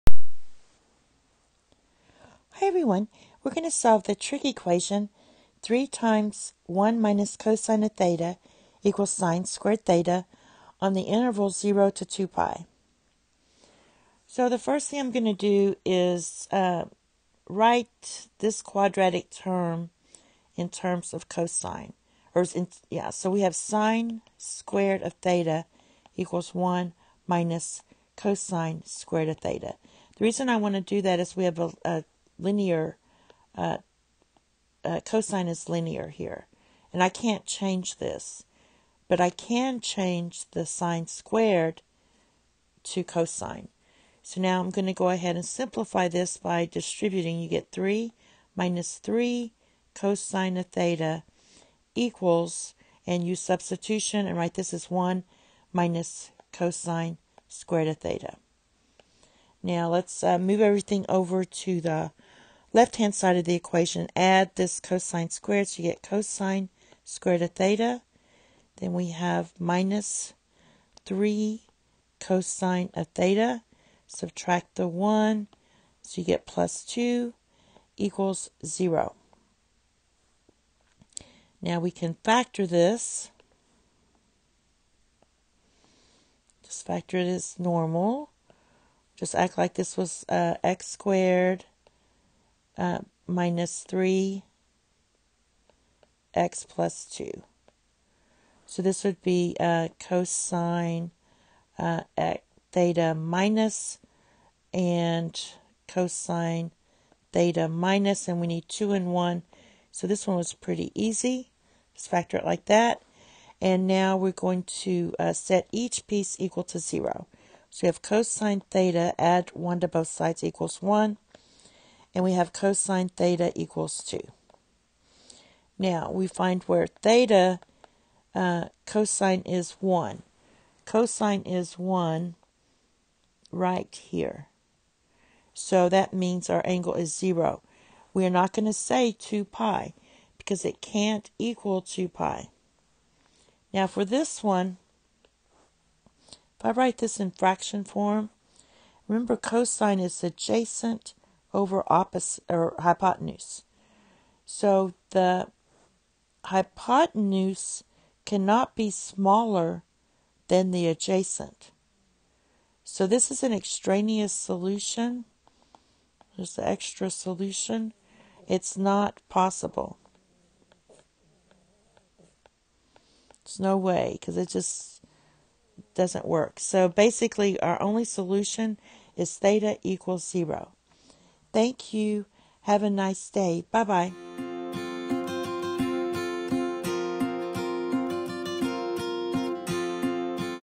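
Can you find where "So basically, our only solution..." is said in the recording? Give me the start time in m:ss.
2:56.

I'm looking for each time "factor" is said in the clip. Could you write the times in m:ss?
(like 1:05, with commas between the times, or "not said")
1:22, 1:26, 1:52.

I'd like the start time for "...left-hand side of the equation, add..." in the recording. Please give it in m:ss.
1:02.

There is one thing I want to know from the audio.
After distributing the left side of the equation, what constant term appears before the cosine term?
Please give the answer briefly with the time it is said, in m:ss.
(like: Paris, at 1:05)
3, at 0:47.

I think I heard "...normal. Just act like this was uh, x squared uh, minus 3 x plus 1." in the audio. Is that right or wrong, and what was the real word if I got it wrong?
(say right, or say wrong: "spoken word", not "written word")
wrong: "2", not "1".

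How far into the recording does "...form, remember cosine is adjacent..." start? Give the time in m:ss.
2:27.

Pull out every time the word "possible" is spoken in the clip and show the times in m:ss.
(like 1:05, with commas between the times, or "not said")
2:49.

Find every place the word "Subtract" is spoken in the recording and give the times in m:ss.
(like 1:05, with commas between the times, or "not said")
1:14.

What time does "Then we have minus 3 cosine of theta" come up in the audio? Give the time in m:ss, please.
1:08.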